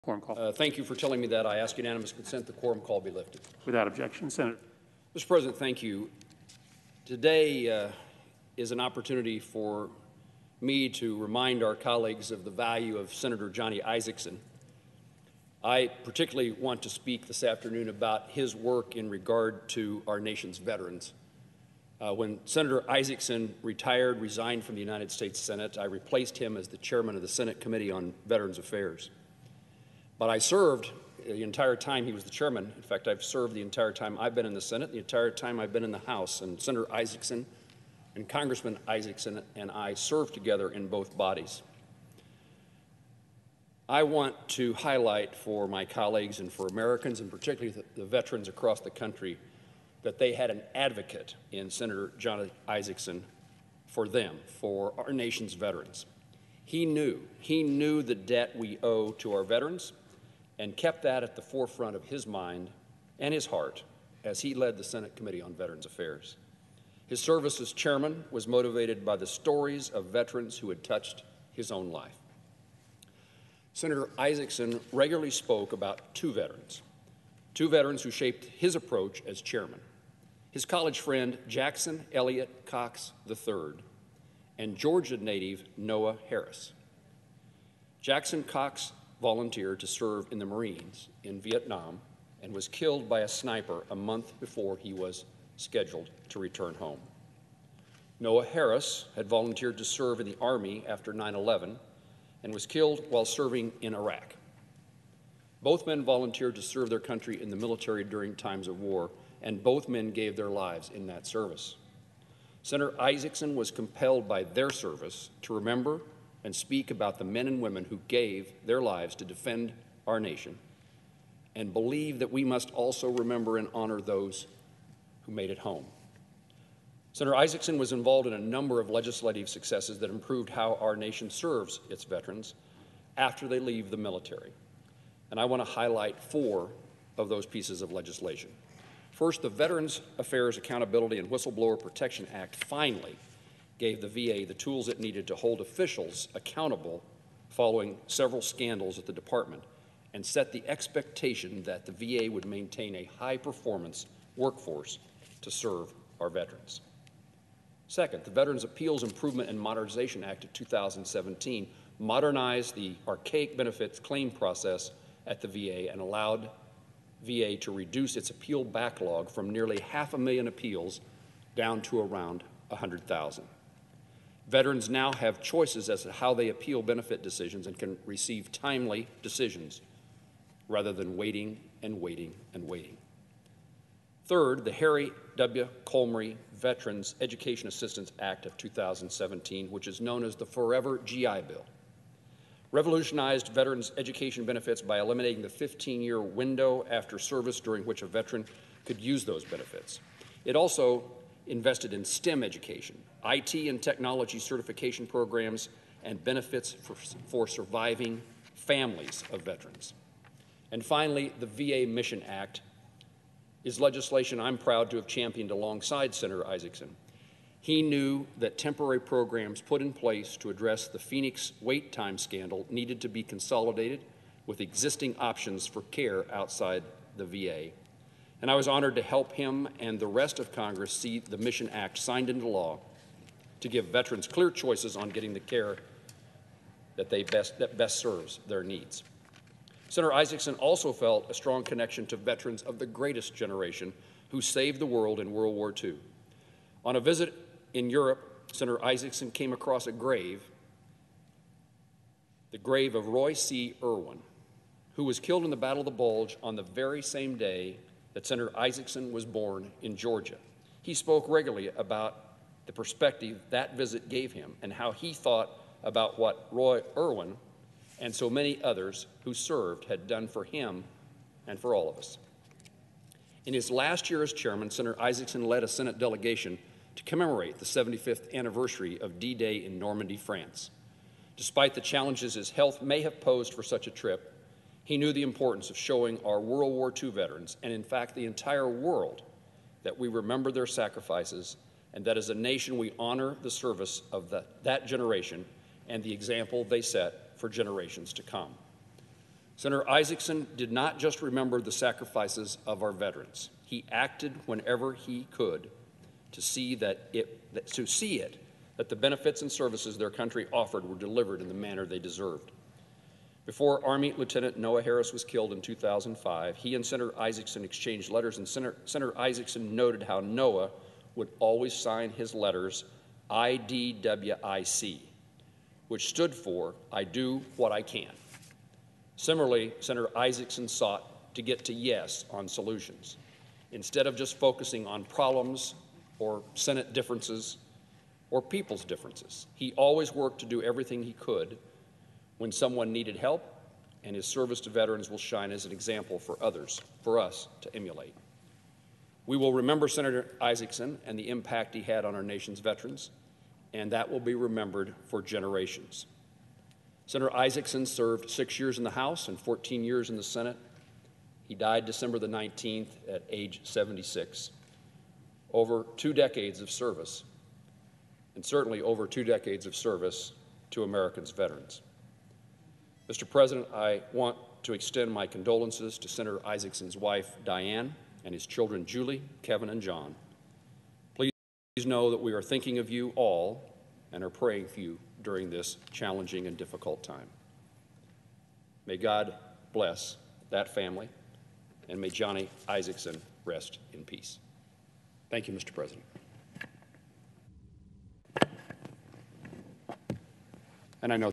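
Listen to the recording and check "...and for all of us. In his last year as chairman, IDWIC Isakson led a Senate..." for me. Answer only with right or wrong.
wrong.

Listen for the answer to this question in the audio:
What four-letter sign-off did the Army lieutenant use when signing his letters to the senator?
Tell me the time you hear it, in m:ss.
5:23.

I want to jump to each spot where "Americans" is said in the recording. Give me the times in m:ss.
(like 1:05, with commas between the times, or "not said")
0:46, 6:10.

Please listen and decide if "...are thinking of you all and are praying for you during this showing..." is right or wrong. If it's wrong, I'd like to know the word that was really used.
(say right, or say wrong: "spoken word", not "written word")
wrong: "challenging", not "showing".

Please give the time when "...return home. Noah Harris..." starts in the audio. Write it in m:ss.
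1:36.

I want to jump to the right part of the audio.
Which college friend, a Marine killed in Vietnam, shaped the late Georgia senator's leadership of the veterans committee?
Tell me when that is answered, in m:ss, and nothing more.
1:21.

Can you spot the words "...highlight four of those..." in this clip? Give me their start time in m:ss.
2:15.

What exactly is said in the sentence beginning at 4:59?
Senator Isakson did not just remember the sacrifices of our veterans.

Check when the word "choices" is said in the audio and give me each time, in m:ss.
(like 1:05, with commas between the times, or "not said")
2:55, 3:54.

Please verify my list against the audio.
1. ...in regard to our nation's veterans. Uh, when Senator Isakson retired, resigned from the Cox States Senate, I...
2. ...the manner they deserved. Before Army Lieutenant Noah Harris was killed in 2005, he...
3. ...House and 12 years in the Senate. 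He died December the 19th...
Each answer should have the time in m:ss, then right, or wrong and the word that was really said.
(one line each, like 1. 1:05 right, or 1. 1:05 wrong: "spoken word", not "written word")
1. 0:18 wrong: "United", not "Cox"
2. 5:11 right
3. 5:58 wrong: "14", not "12".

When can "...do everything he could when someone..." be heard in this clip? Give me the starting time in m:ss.
5:40.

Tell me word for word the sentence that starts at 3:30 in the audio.
And finally, the VA Mission Act is legislation I'm proud to have championed alongside Senator Isakson.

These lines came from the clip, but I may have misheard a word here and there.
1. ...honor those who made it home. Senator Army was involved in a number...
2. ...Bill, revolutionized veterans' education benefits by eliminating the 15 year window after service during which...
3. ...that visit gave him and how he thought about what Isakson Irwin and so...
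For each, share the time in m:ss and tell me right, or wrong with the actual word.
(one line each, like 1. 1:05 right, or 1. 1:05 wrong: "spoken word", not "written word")
1. 2:03 wrong: "Isakson", not "Army"
2. 3:11 right
3. 4:23 wrong: "Roy", not "Isakson".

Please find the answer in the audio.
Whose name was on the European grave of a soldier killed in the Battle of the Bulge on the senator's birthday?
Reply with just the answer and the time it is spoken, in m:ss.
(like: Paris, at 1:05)
Roy C. Irwin, at 4:13.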